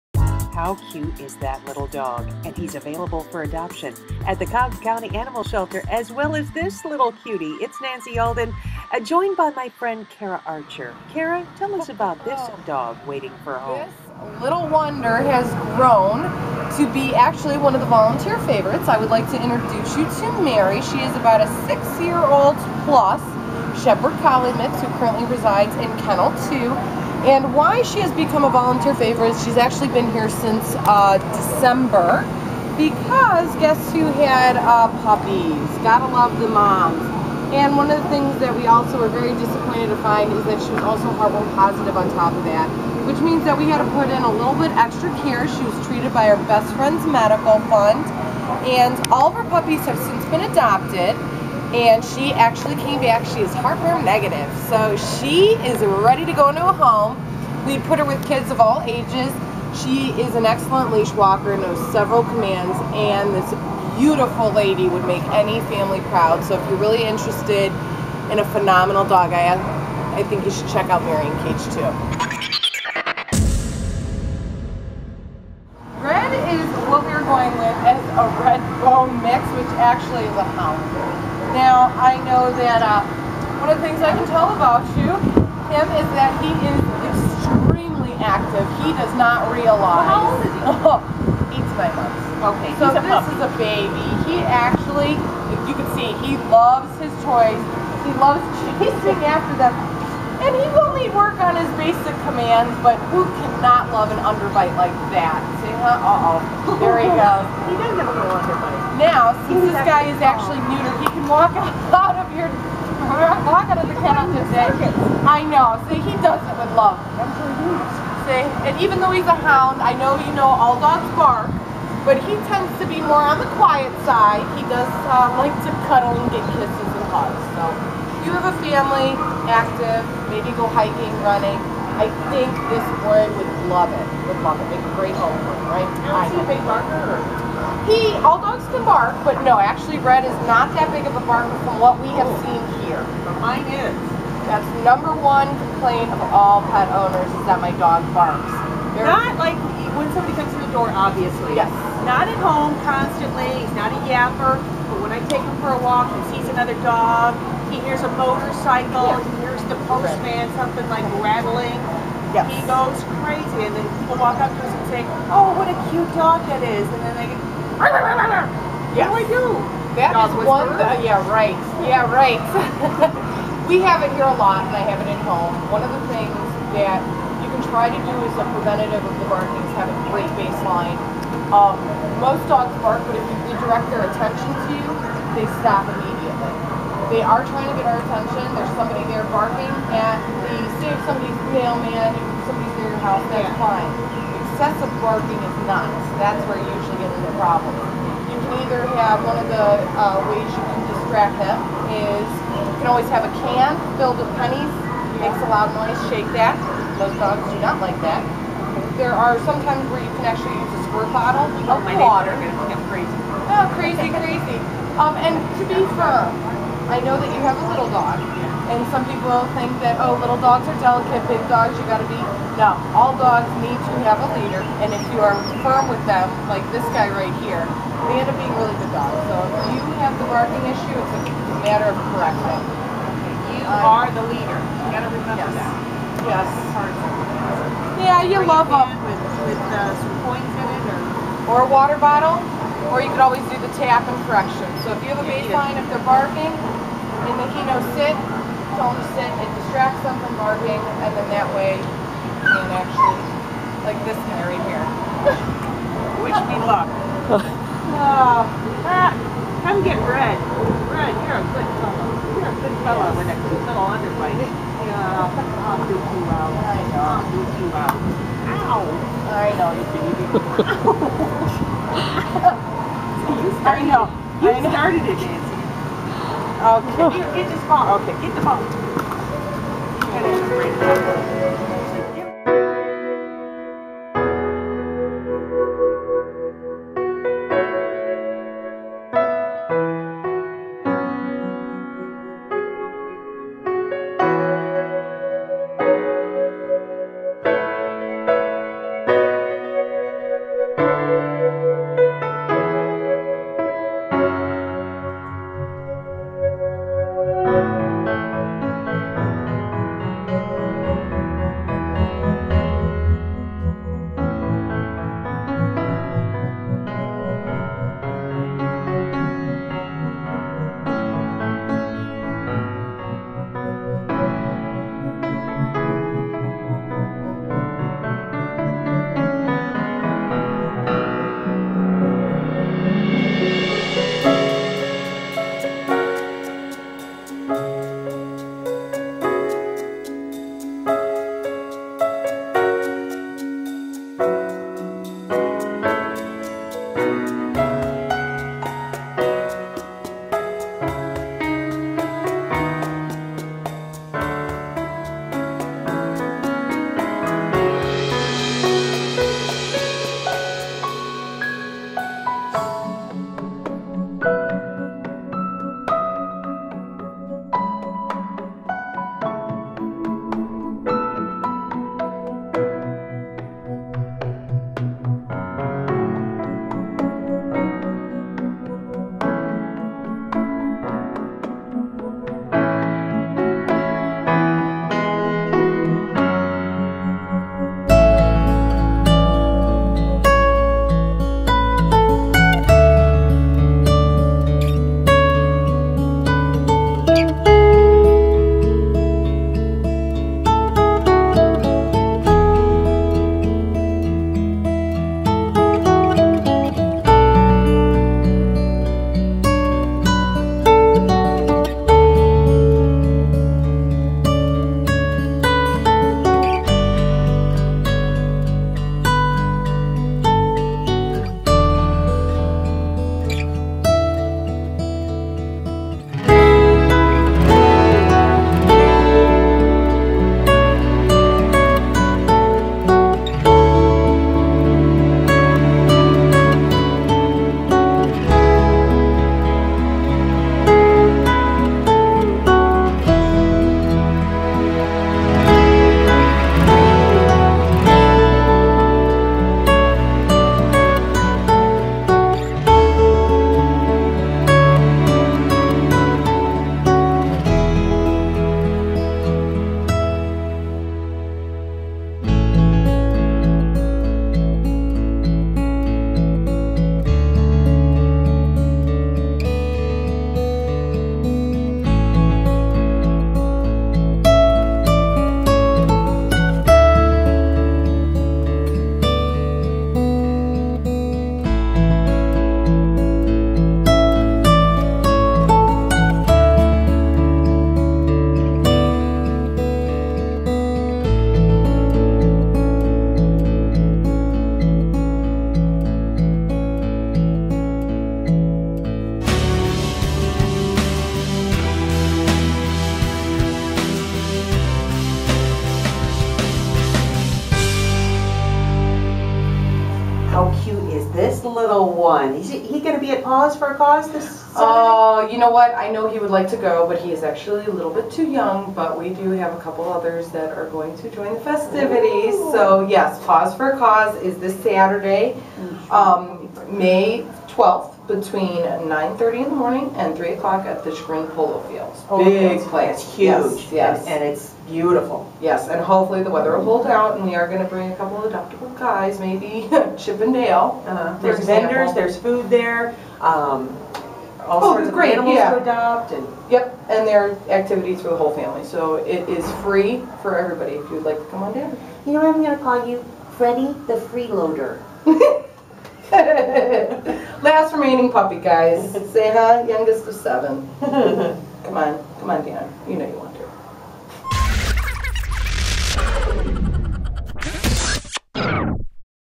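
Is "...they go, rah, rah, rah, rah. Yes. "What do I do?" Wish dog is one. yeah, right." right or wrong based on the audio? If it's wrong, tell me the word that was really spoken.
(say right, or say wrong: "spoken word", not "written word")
wrong: "That", not "Wish".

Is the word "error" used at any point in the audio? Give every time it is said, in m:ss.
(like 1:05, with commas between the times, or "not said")
not said.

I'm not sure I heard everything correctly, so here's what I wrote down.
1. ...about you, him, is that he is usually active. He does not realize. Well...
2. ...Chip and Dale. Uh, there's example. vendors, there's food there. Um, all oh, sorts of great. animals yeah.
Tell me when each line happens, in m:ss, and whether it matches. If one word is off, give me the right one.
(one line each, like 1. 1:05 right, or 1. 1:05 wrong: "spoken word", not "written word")
1. 1:24 wrong: "extremely", not "usually"
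2. 8:59 right.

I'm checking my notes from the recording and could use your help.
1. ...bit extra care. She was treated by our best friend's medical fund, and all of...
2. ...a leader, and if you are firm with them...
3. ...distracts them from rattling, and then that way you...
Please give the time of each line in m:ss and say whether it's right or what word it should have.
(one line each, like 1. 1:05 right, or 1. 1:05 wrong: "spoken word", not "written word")
1. 0:44 right
2. 3:44 right
3. 4:09 wrong: "barking", not "rattling".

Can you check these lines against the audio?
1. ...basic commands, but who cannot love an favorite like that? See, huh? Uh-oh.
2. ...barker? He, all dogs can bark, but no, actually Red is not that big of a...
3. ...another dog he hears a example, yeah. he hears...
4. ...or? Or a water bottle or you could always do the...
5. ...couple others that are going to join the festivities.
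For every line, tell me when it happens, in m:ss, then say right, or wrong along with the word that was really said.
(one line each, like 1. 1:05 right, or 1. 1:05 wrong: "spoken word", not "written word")
1. 1:41 wrong: "underbite", not "favorite"
2. 2:16 right
3. 2:36 wrong: "motorcycle", not "example"
4. 4:00 right
5. 8:39 right.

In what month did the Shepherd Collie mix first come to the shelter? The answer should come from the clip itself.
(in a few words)
December.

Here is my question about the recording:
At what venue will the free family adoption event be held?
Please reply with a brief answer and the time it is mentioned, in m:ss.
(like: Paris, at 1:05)
Green Polo Fields, at 8:51.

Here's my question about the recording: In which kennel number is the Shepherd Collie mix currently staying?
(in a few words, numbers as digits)
Kennel 2.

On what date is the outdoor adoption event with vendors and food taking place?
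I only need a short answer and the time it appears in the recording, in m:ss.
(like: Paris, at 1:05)
May 12th, at 8:46.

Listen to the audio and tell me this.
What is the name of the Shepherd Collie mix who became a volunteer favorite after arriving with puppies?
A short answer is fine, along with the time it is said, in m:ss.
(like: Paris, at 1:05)
Mary, at 0:20.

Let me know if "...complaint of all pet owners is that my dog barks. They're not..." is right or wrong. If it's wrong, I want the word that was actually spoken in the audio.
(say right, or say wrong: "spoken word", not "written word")
right.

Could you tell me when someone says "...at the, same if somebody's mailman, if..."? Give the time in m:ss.
3:09.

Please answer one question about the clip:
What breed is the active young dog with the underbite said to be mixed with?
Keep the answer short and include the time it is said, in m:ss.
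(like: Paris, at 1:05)
Red bone, at 1:18.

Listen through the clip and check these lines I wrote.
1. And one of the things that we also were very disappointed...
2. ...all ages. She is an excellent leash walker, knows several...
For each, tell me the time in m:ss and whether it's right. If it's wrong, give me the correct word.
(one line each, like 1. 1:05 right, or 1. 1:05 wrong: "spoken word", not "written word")
1. 0:37 right
2. 0:58 right.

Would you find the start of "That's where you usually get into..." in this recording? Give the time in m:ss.
3:16.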